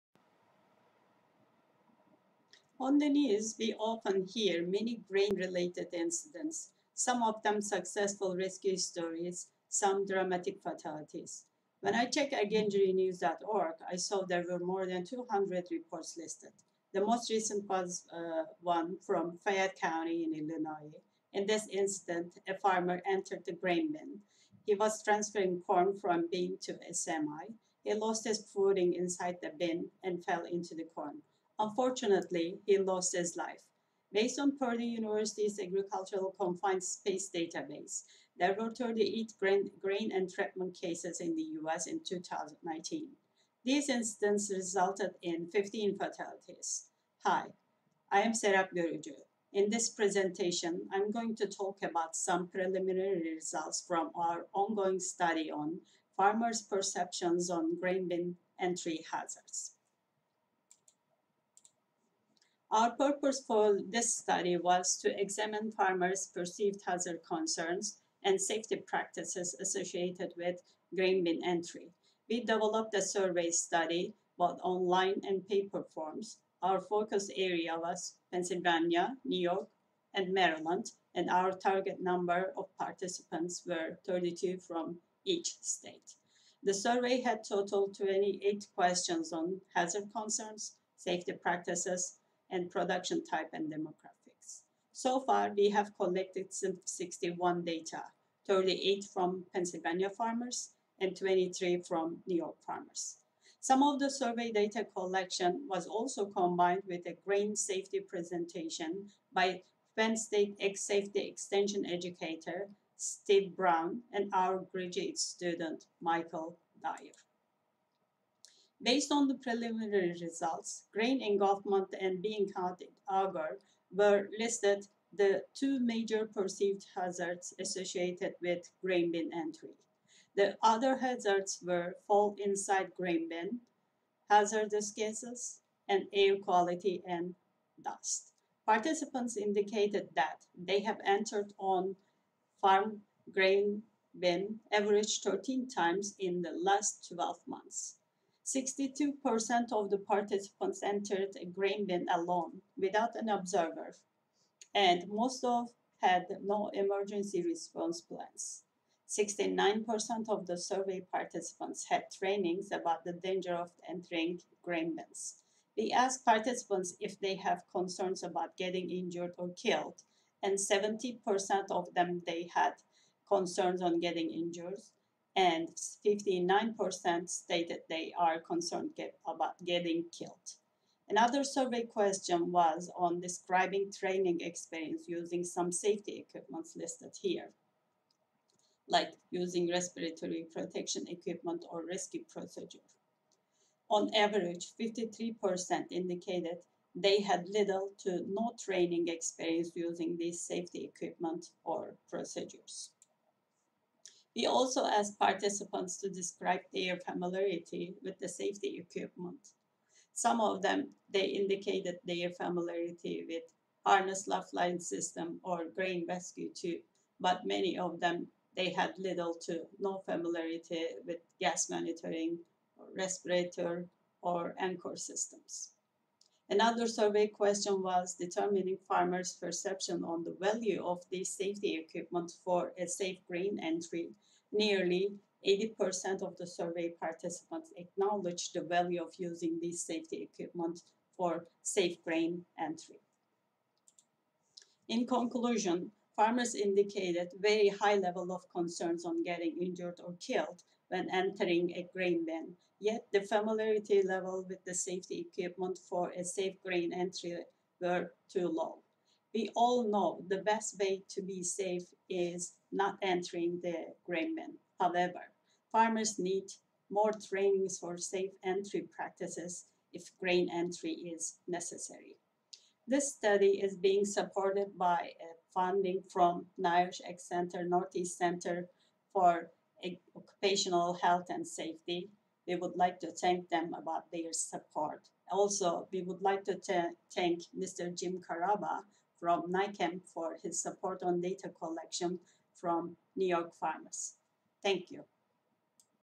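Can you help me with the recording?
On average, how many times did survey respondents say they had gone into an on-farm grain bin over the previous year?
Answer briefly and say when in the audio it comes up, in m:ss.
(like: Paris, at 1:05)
13, at 2:25.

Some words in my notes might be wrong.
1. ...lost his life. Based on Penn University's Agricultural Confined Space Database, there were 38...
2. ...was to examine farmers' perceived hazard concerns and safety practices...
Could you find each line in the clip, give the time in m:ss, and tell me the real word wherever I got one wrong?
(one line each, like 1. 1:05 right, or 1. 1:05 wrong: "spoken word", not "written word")
1. 0:32 wrong: "Purdue", not "Penn"
2. 1:04 right.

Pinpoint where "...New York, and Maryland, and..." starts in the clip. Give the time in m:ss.
1:19.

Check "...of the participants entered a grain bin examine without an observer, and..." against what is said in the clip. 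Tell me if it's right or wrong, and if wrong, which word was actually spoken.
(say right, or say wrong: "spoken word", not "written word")
wrong: "alone", not "examine".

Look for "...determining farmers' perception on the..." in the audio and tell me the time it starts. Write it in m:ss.
3:48.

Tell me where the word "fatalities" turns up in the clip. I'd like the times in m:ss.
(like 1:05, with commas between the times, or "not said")
0:10, 0:45.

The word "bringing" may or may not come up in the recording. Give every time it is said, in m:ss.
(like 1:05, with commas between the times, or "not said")
not said.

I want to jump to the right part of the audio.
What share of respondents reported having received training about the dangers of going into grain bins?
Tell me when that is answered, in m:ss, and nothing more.
2:39.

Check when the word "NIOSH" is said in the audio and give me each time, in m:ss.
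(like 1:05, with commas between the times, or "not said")
4:36.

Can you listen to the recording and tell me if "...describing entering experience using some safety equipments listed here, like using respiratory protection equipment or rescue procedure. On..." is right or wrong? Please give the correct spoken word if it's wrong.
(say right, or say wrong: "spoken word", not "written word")
wrong: "training", not "entering".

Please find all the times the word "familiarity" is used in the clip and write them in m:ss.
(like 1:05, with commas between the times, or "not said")
3:26, 3:32, 3:40, 4:13.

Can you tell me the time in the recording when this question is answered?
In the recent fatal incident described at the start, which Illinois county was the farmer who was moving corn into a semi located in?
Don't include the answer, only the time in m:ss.
0:19.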